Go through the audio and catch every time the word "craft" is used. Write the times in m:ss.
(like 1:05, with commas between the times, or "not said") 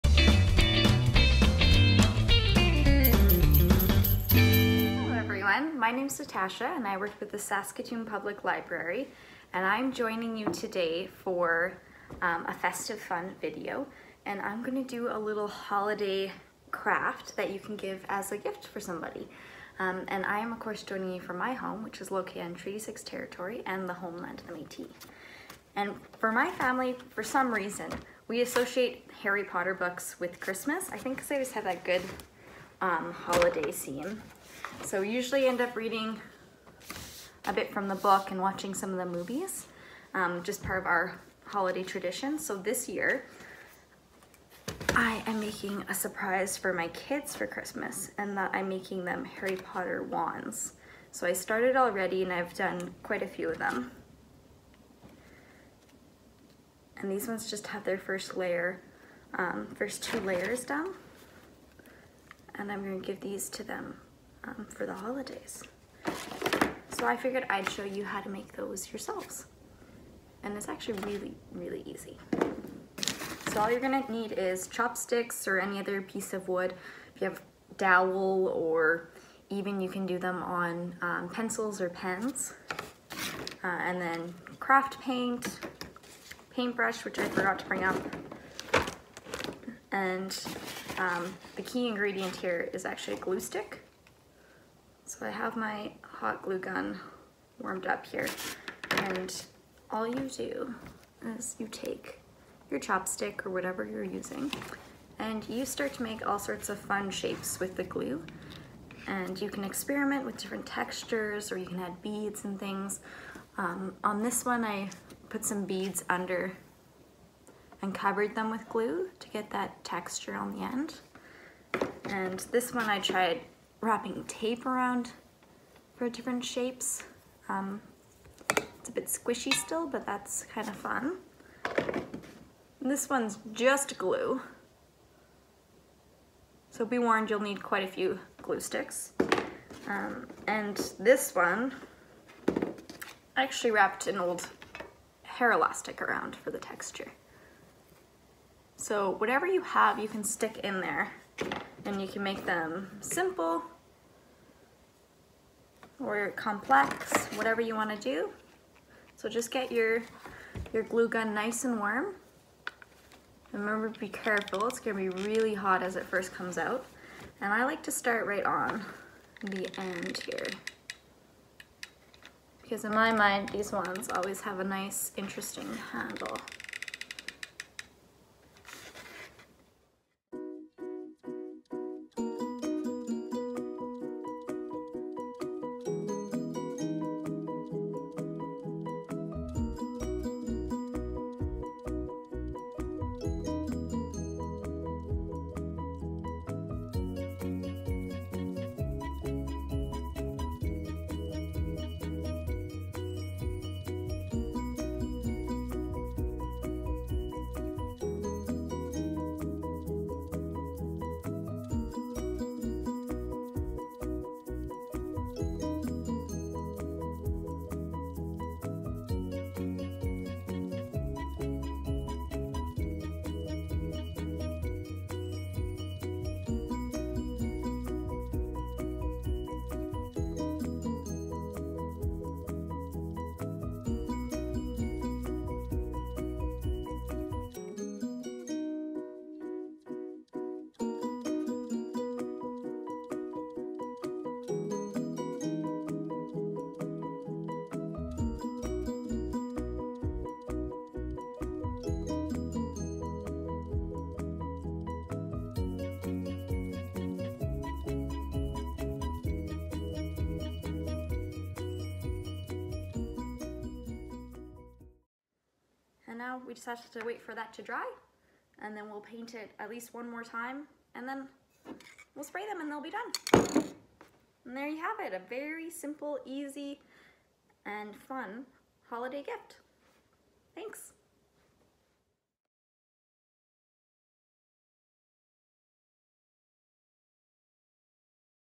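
0:16, 1:24.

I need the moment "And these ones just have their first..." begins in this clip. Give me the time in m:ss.
0:56.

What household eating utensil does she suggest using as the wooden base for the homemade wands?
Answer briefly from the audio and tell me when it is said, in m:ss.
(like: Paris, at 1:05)
Chopsticks, at 1:14.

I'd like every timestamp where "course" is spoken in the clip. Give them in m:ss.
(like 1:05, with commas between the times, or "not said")
0:20.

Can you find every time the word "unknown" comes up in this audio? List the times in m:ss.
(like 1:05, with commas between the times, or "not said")
not said.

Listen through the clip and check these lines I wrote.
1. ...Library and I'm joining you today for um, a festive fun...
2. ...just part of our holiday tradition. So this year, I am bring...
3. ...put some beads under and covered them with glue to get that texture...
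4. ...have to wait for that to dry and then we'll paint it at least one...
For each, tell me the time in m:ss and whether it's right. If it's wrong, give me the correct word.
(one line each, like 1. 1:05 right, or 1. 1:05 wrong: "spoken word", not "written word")
1. 0:08 right
2. 0:40 wrong: "making", not "bring"
3. 1:55 right
4. 4:26 right.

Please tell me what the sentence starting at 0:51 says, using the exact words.
So I started already and I've done quite a few of them.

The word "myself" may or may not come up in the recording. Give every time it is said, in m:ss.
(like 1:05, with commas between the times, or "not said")
not said.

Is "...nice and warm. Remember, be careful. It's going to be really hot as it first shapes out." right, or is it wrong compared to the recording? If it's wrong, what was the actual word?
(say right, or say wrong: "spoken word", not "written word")
wrong: "comes", not "shapes".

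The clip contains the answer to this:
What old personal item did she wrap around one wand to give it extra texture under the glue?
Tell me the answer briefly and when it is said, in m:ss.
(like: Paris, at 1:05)
Hair elastic, at 2:25.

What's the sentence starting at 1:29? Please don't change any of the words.
And um, the key ingredient here is actually a glue stick.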